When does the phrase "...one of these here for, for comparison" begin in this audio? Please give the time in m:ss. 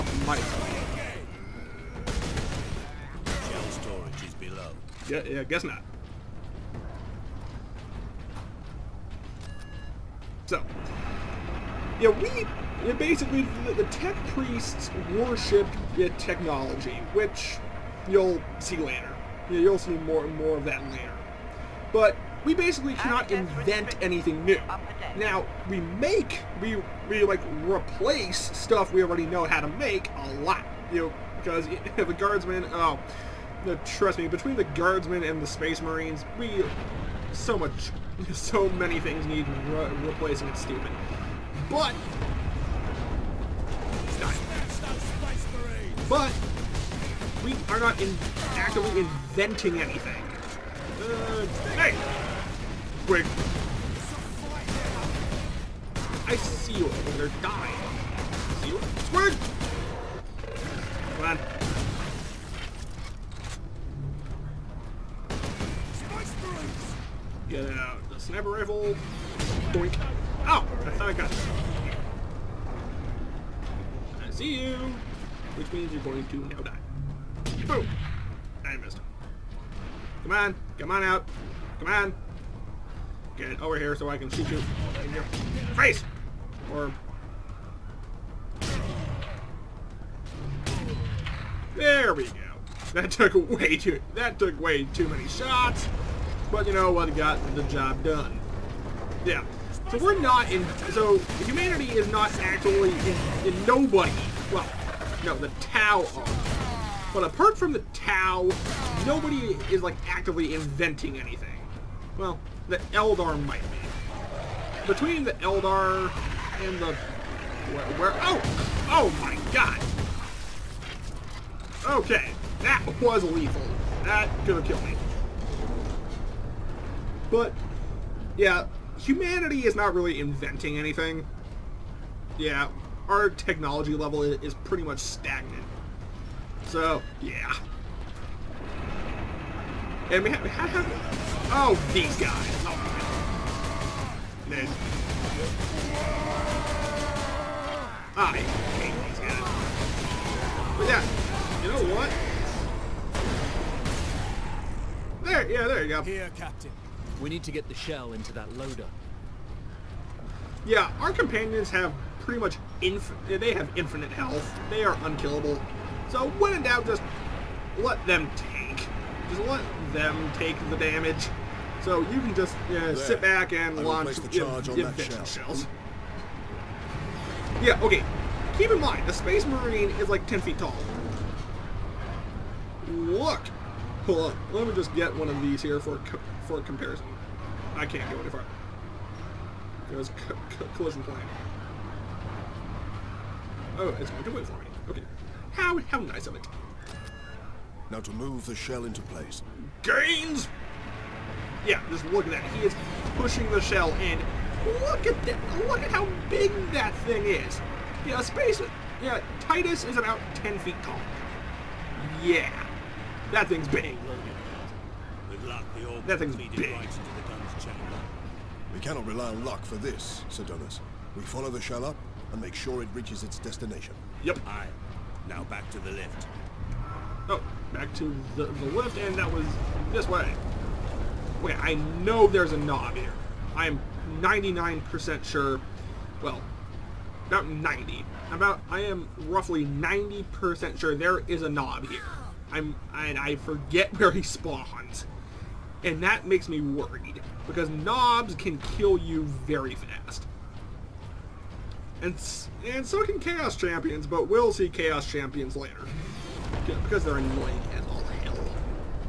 3:05.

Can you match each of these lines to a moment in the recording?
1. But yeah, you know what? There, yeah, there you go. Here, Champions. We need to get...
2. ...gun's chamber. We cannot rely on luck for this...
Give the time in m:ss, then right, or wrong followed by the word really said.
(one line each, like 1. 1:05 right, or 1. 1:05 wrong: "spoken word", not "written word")
1. 2:30 wrong: "Captain", not "Champions"
2. 3:37 right.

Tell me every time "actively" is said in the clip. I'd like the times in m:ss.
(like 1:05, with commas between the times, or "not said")
0:48, 1:50.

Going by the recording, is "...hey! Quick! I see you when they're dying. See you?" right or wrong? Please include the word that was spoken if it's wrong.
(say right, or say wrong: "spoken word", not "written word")
right.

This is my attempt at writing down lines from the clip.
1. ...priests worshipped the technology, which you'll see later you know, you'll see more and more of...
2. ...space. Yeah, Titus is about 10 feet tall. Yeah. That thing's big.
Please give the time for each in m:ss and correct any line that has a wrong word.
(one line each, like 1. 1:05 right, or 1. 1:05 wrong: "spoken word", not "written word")
1. 0:14 right
2. 3:28 right.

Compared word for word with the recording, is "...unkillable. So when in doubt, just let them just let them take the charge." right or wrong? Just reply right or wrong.
wrong.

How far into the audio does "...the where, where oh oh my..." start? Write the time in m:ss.
1:56.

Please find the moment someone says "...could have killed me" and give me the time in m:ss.
2:04.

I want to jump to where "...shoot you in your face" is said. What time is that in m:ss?
1:24.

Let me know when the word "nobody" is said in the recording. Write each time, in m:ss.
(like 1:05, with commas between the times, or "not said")
1:43, 1:49.